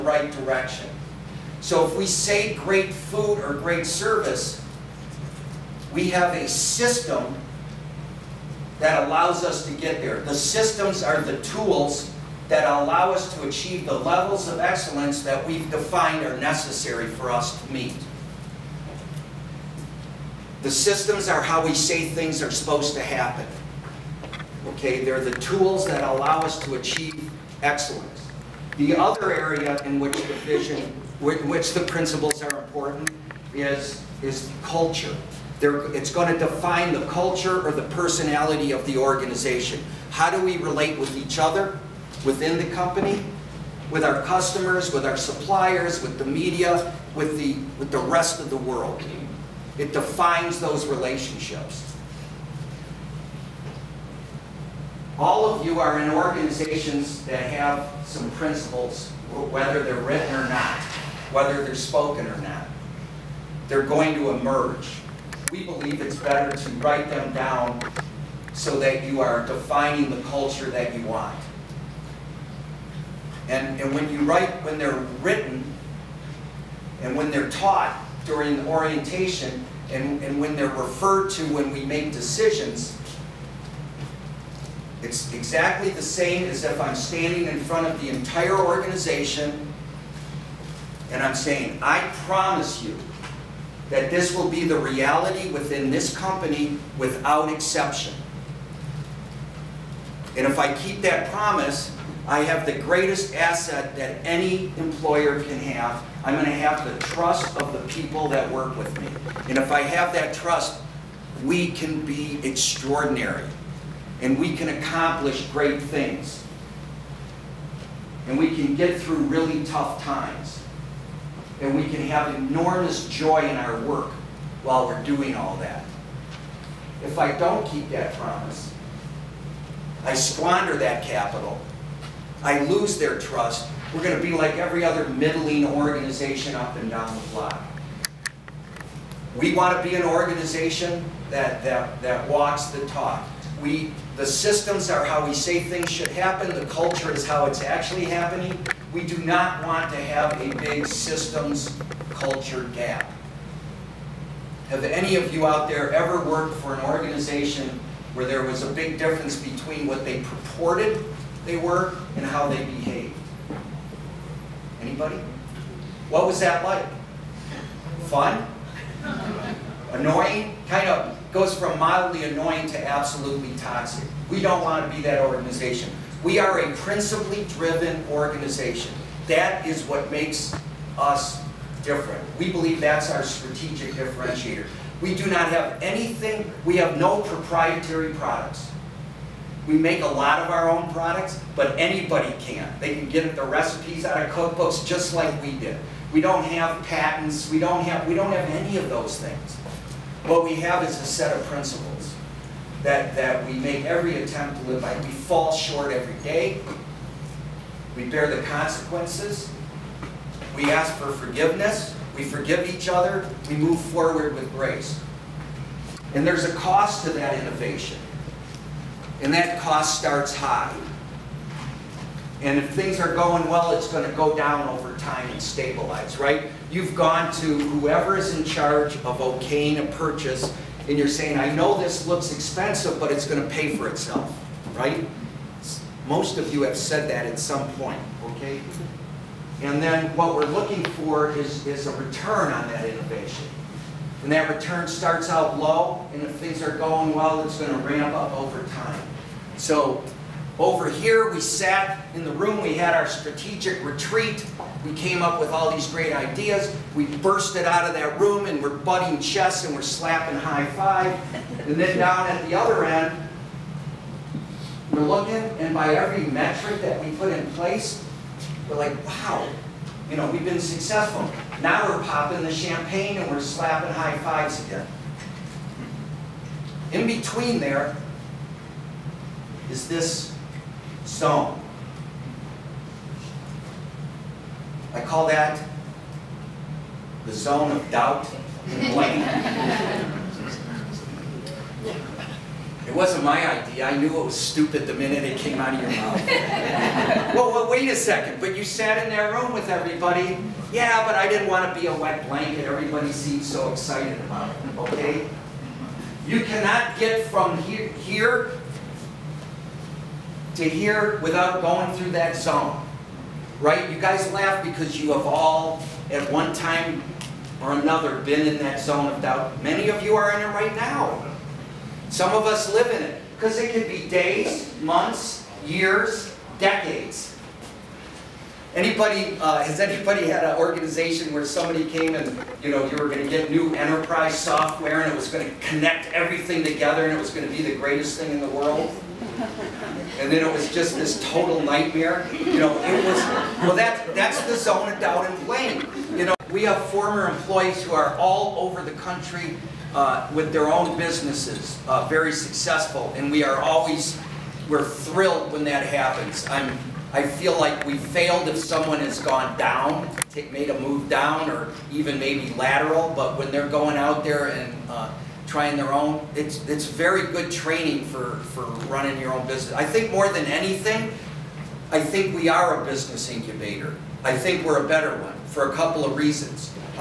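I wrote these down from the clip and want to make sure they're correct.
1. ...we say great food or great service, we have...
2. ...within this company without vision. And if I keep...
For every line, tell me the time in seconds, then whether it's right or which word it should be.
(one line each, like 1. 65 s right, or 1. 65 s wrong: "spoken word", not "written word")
1. 1 s right
2. 95 s wrong: "exception", not "vision".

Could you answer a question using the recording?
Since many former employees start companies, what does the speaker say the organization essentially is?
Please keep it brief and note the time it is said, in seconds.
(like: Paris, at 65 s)
business incubator, at 372 s.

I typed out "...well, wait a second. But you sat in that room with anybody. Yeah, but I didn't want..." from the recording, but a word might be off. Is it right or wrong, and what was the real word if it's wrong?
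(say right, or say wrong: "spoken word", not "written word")
wrong: "everybody", not "anybody".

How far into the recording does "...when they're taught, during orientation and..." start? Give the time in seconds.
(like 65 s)
77 s.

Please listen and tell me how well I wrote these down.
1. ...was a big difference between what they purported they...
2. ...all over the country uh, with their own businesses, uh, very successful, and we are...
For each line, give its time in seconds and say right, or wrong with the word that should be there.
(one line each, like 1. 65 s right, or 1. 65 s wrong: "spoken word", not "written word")
1. 158 s right
2. 348 s right.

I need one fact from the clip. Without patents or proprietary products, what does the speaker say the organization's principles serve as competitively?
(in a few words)
strategic differentiator.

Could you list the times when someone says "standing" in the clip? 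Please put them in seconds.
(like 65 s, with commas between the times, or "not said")
86 s.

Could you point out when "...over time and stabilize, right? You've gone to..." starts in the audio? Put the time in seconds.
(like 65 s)
224 s.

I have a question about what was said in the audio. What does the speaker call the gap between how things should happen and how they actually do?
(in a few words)
systems culture gap.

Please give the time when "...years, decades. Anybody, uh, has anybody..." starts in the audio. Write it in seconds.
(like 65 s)
325 s.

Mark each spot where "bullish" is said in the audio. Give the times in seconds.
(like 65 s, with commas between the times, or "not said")
not said.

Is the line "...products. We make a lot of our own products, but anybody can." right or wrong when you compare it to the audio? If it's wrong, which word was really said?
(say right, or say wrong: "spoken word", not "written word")
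right.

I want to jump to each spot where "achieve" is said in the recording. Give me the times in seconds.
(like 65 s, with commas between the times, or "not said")
13 s, 26 s.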